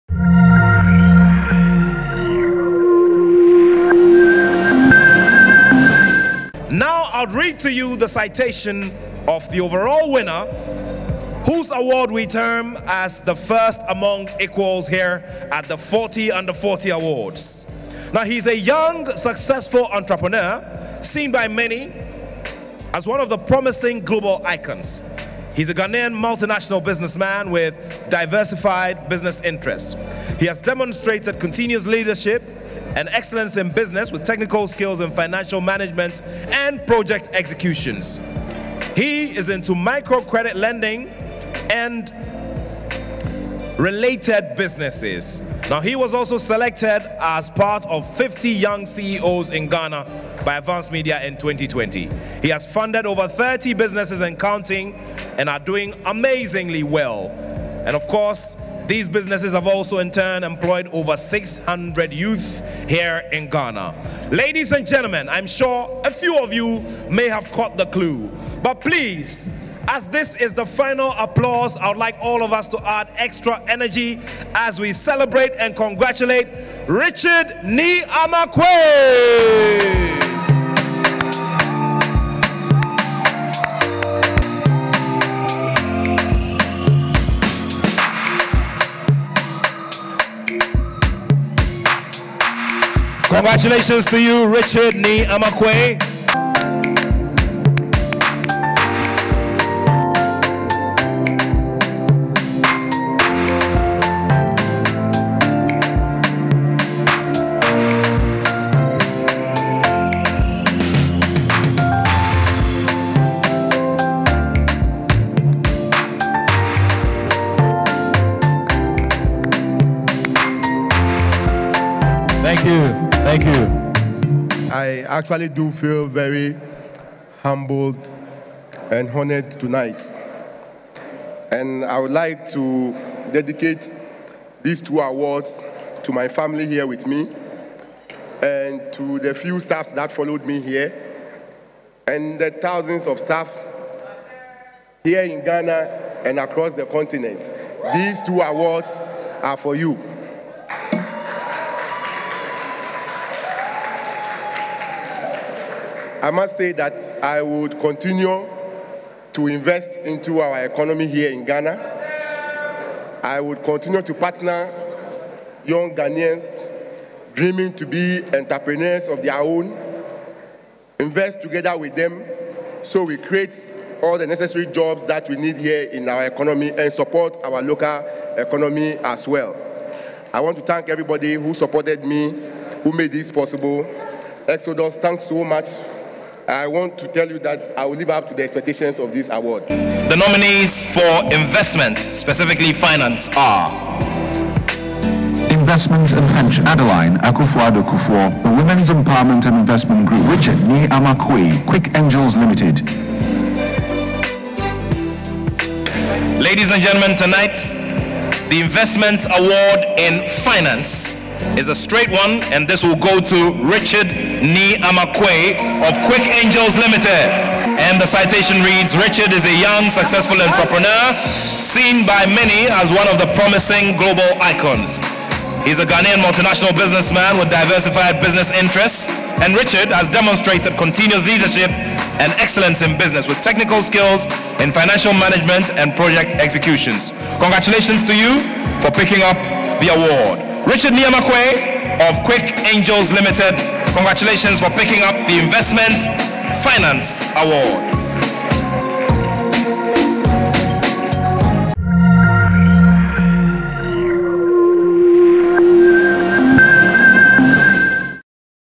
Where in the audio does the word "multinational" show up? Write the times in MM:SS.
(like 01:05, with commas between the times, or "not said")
00:26, 03:46.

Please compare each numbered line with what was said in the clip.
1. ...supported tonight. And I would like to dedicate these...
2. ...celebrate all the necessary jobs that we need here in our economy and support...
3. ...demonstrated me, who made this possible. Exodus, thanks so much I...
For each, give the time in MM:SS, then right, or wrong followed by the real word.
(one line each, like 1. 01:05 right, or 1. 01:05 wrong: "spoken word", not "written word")
1. 02:09 wrong: "honored", not "supported"
2. 02:53 wrong: "create", not "celebrate"
3. 03:01 wrong: "supported", not "demonstrated".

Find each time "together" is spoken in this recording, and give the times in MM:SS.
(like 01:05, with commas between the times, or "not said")
02:51.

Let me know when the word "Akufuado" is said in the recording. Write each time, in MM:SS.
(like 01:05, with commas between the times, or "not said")
03:17.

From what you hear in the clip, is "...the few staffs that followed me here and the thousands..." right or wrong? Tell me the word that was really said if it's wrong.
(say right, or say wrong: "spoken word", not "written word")
right.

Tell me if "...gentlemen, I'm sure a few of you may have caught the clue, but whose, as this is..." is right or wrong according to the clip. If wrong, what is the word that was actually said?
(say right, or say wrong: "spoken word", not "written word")
wrong: "please", not "whose".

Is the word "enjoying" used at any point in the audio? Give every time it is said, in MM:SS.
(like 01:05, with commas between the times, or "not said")
not said.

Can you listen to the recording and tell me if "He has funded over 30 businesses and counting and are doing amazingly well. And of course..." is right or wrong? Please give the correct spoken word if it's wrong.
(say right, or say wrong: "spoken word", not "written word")
right.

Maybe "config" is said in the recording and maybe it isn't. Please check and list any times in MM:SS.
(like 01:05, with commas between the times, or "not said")
not said.